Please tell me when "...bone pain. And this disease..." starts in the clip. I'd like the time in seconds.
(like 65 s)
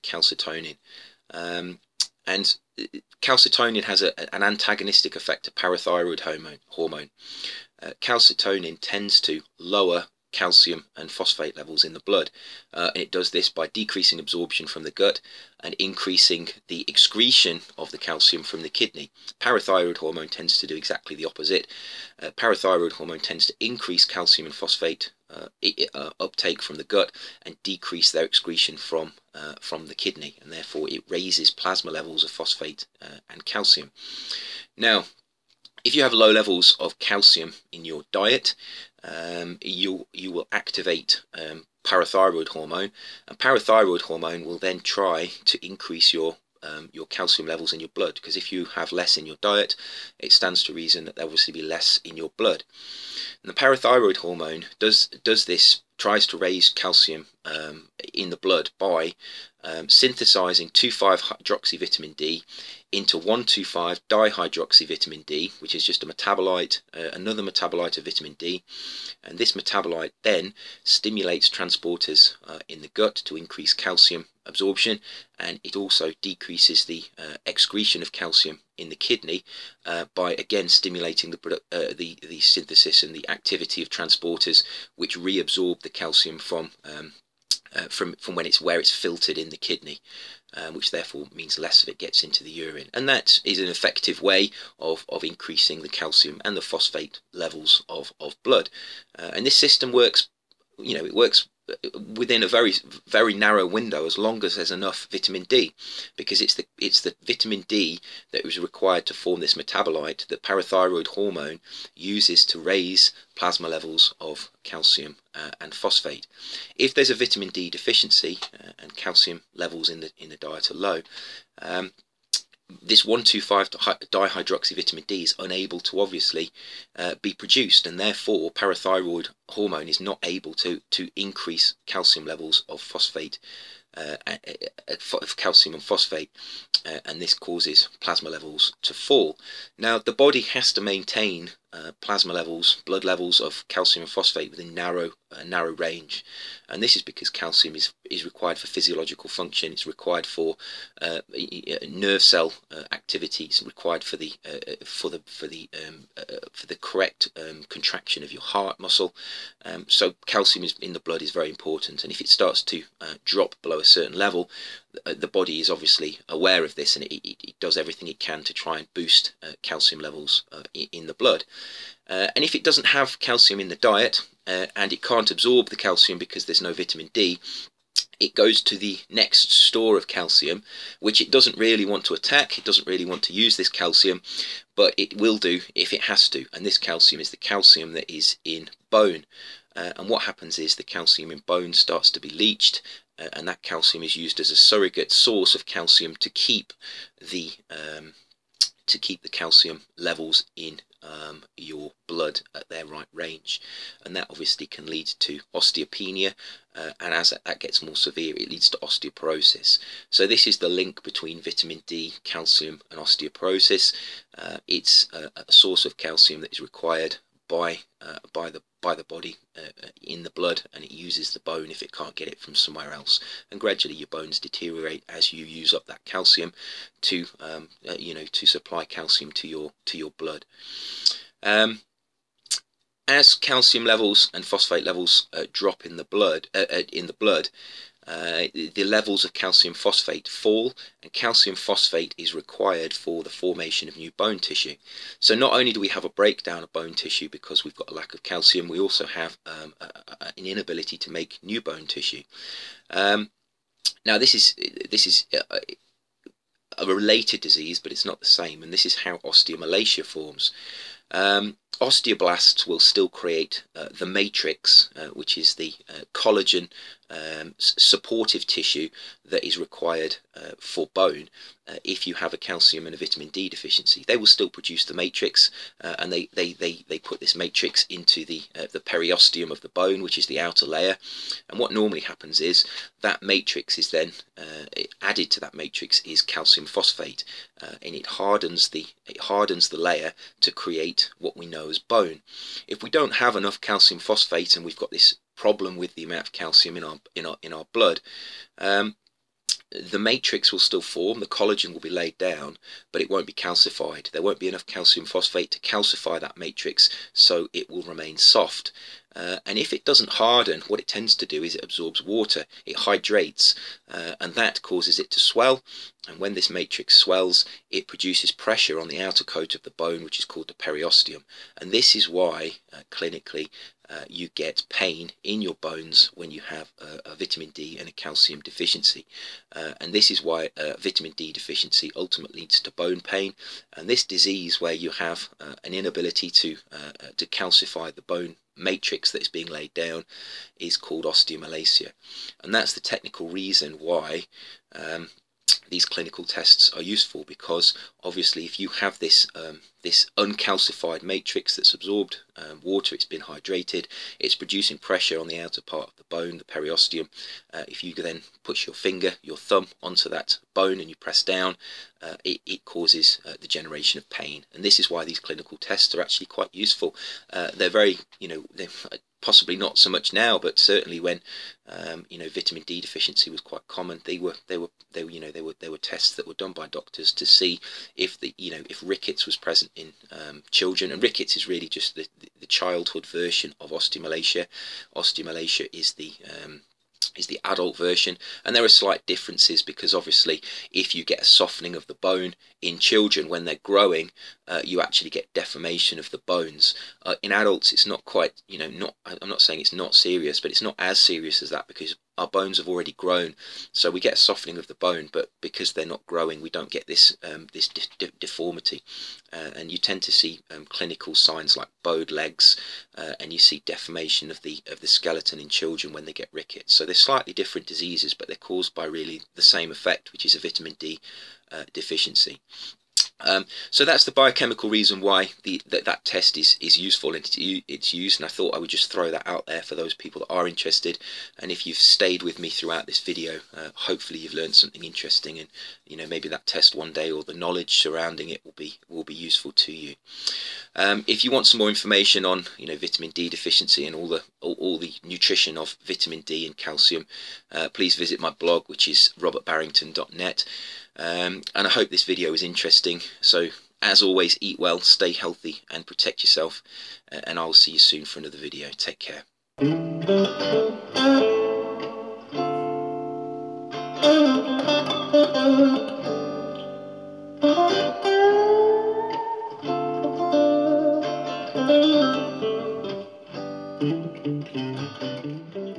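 332 s.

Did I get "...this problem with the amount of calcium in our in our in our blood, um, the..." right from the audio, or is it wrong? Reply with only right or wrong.
right.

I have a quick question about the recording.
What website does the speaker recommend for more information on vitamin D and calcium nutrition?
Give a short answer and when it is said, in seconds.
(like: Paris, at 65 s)
robertbarrington.net, at 449 s.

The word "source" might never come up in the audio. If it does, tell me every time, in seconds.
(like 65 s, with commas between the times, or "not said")
195 s, 215 s.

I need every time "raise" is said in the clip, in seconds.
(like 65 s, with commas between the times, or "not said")
31 s, 56 s, 112 s.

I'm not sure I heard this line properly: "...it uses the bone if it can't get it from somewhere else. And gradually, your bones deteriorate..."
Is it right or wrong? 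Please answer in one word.
right.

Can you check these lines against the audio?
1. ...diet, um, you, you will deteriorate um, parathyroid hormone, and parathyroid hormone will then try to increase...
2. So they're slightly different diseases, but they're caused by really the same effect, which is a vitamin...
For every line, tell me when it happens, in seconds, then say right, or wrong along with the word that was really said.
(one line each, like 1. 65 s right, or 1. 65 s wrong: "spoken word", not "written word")
1. 38 s wrong: "activate", not "deteriorate"
2. 416 s right.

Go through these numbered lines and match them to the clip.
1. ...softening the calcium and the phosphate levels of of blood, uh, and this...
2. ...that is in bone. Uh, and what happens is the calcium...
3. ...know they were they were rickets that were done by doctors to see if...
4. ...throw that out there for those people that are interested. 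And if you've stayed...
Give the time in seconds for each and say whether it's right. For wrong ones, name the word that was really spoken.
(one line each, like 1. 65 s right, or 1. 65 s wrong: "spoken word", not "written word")
1. 95 s wrong: "increasing", not "softening"
2. 187 s right
3. 375 s wrong: "tests", not "rickets"
4. 428 s right.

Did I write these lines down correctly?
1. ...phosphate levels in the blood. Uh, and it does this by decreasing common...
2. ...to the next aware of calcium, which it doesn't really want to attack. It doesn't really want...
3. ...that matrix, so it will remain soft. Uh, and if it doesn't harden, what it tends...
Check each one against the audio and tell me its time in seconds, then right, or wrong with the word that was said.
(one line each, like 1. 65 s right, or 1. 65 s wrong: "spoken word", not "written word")
1. 11 s wrong: "absorption", not "common"
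2. 178 s wrong: "store", not "aware"
3. 306 s right.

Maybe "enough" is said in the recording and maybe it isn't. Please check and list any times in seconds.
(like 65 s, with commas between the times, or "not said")
104 s, 293 s, 304 s.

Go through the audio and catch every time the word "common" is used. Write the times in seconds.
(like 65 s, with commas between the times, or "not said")
373 s.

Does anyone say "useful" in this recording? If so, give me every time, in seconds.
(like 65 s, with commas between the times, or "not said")
346 s, 366 s, 426 s, 439 s.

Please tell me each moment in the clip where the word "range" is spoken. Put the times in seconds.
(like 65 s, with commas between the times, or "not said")
145 s, 203 s.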